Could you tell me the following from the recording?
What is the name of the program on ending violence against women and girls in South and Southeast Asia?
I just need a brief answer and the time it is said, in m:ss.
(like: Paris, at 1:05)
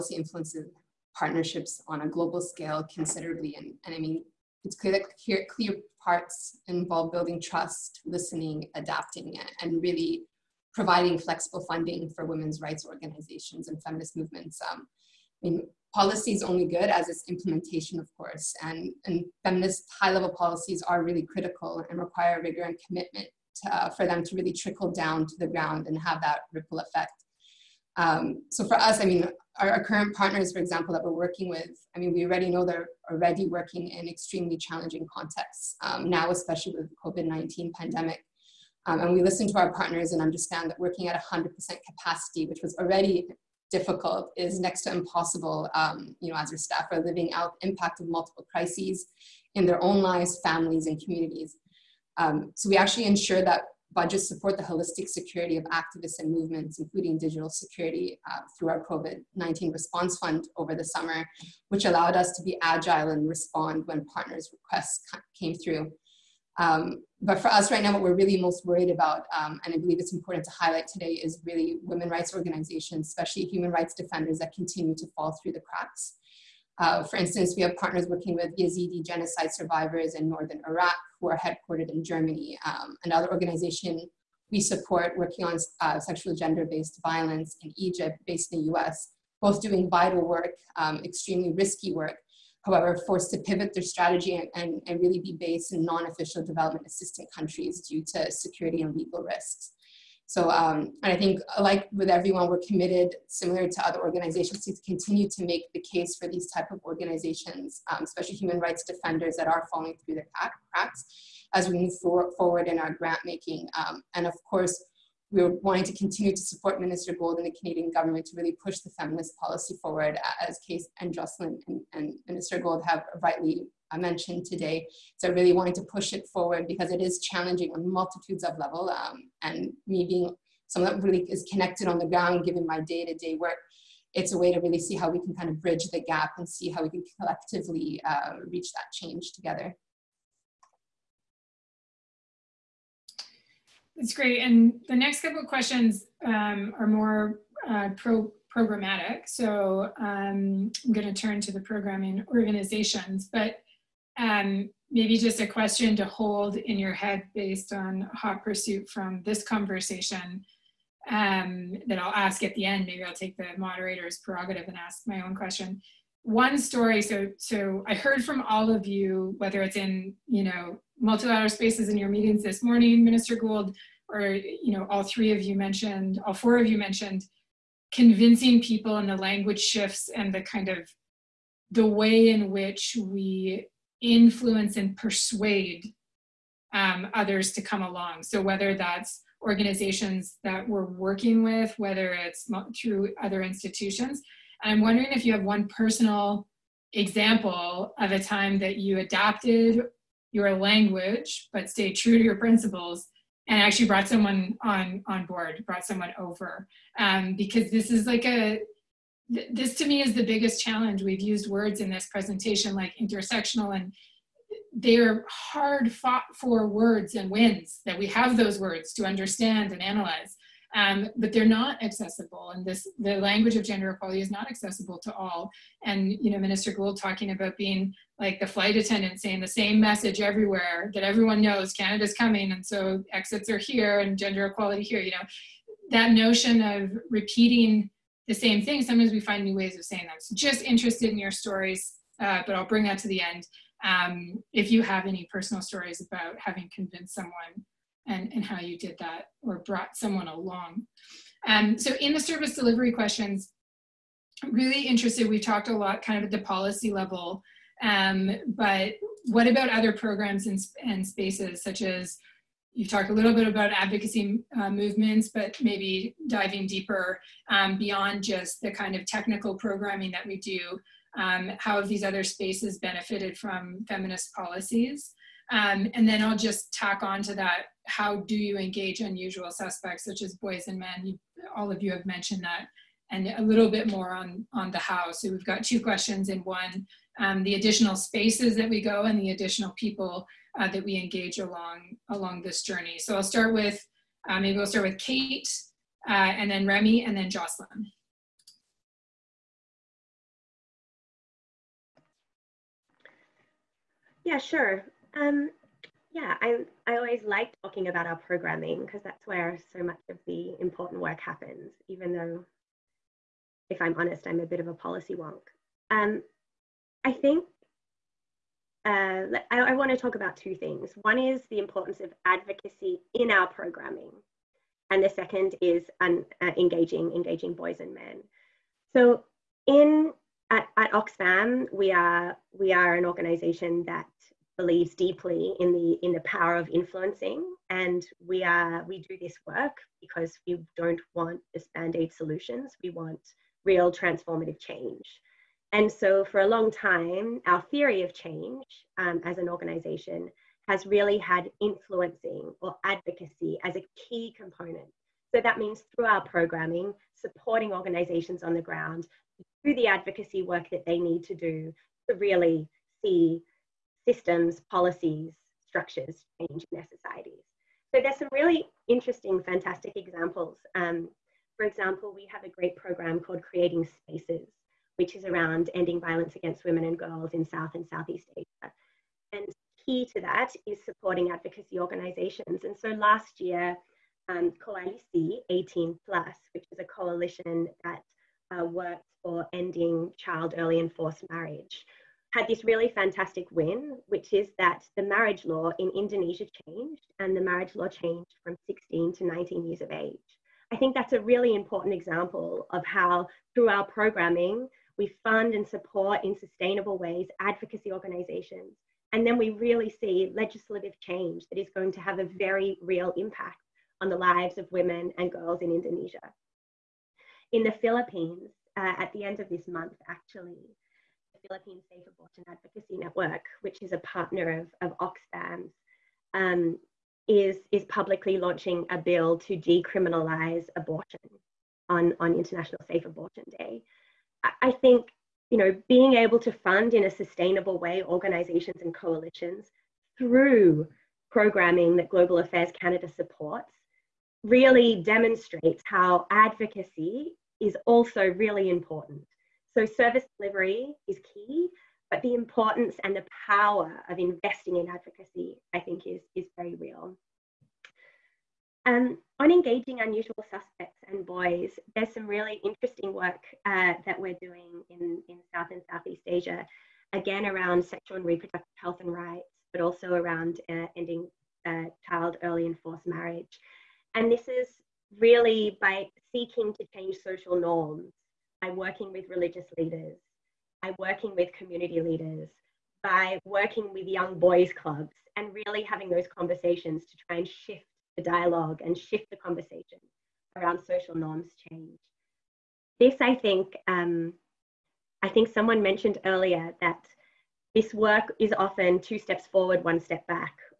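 Creating Spaces, at 6:13.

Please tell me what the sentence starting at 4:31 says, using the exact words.
Um, how have these other spaces benefited from feminist policies?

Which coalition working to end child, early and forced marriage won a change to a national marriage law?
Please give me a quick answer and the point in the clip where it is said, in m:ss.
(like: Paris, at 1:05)
Koalisi 18 Plus, at 6:24.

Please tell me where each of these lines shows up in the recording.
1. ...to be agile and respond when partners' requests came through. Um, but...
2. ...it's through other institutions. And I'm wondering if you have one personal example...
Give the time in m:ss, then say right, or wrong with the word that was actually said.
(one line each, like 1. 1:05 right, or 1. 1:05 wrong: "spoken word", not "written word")
1. 1:02 right
2. 3:12 right.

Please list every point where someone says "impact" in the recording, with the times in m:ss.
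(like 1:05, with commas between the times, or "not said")
0:47, 6:53.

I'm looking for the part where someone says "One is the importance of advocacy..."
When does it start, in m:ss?
5:21.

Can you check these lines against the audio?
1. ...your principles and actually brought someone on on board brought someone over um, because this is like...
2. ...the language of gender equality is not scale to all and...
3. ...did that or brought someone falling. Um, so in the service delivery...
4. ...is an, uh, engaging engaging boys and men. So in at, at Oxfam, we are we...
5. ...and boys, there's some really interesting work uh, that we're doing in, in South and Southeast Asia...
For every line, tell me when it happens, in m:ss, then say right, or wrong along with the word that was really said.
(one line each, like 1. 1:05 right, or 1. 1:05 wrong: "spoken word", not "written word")
1. 3:22 right
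2. 3:42 wrong: "accessible", not "scale"
3. 4:08 wrong: "along", not "falling"
4. 5:25 right
5. 7:41 right.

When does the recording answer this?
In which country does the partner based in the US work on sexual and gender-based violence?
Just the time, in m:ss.
1:27.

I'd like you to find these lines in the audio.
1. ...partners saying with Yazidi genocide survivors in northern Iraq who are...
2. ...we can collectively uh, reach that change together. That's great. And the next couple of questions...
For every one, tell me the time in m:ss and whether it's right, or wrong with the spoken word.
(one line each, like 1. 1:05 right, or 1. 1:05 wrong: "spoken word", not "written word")
1. 1:17 wrong: "working", not "saying"
2. 2:16 right.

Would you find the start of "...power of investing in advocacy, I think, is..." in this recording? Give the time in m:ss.
7:33.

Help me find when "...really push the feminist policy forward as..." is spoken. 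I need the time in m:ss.
1:58.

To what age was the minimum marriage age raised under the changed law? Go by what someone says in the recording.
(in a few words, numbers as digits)
19.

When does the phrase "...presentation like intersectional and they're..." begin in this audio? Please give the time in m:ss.
3:32.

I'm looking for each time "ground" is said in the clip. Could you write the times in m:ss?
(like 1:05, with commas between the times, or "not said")
0:25, 2:12, 5:58.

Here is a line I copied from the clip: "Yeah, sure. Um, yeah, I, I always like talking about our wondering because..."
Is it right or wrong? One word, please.
wrong.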